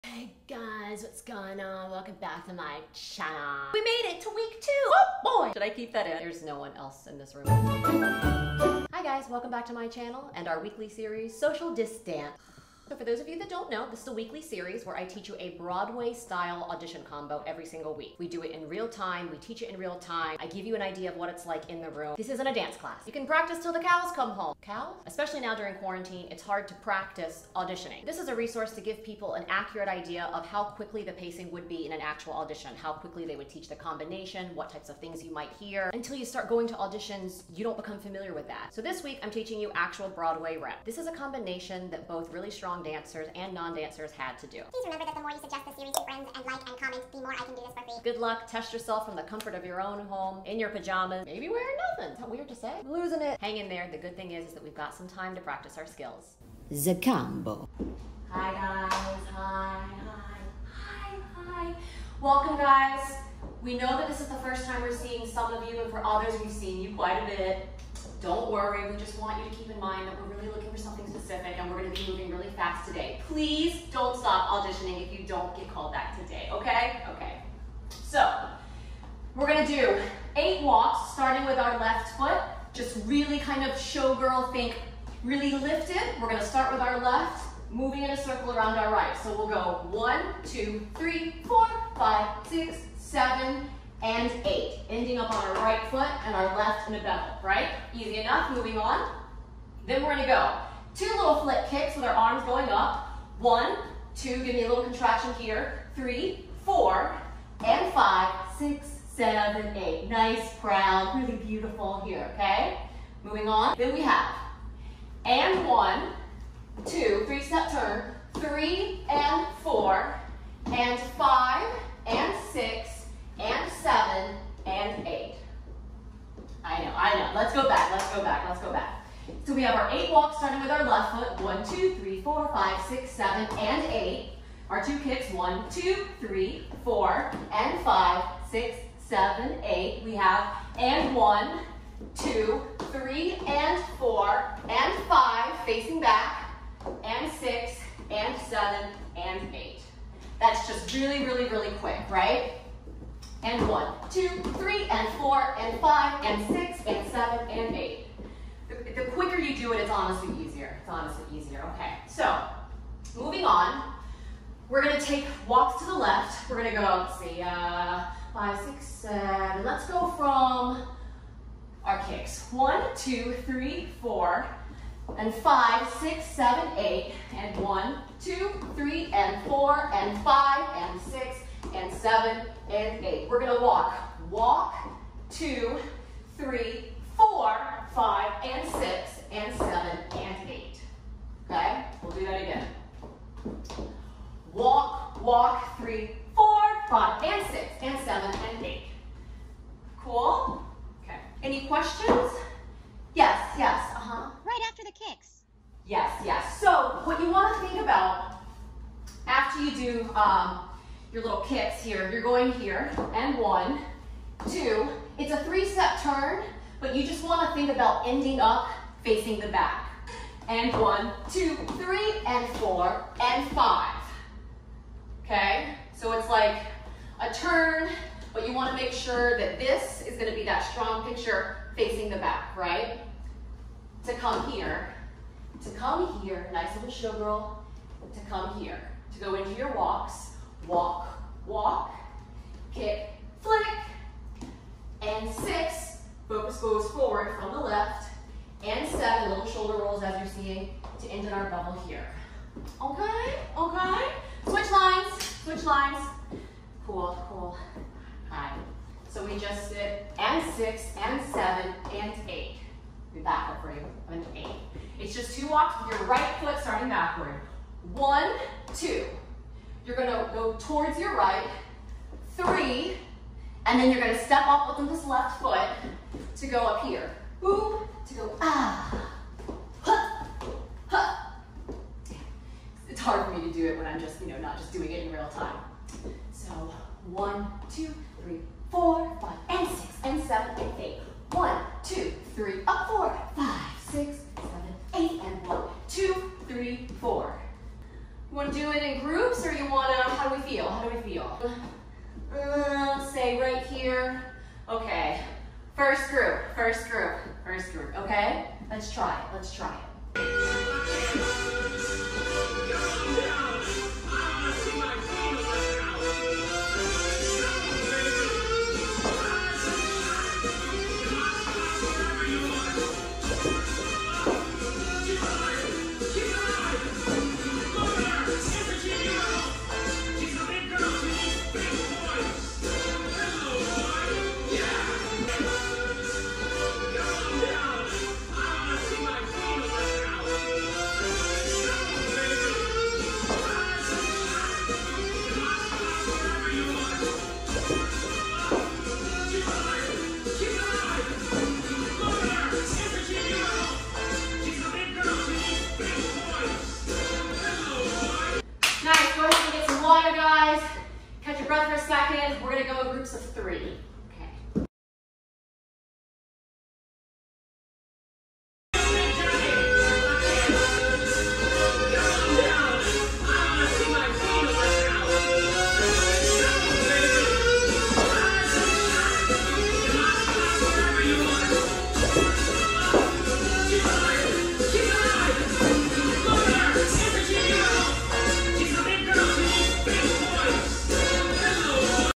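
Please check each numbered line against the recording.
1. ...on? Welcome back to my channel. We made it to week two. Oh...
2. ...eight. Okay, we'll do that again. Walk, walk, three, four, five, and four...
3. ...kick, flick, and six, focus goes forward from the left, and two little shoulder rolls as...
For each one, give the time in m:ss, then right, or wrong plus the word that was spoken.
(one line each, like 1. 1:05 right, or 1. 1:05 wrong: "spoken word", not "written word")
1. 0:01 right
2. 3:10 wrong: "six", not "four"
3. 4:02 wrong: "seven", not "two".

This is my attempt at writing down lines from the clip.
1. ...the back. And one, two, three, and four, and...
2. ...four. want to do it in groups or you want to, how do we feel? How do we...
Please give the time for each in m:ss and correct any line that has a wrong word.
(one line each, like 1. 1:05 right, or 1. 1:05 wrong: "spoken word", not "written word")
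1. 3:39 right
2. 4:56 right.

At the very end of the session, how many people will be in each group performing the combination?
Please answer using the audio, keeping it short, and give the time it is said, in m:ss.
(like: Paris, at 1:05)
3, at 6:02.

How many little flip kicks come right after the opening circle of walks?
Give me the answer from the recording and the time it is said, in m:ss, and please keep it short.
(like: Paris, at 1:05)
2, at 1:40.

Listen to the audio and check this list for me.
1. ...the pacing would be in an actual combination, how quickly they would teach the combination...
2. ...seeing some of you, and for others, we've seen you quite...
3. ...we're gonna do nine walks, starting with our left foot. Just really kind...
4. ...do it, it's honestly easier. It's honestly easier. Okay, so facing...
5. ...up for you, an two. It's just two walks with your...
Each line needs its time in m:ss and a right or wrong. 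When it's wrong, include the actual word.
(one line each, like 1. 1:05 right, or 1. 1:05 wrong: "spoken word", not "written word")
1. 0:31 wrong: "audition", not "combination"
2. 1:04 right
3. 1:19 wrong: "eight", not "nine"
4. 2:39 wrong: "moving", not "facing"
5. 4:23 wrong: "eight", not "two".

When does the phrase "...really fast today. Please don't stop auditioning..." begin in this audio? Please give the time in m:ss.
1:12.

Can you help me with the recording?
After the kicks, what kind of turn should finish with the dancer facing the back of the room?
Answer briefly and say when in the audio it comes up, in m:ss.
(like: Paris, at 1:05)
Three-step turn, at 3:35.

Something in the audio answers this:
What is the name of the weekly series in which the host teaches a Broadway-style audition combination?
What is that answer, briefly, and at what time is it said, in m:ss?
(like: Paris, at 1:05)
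Social Distance, at 0:11.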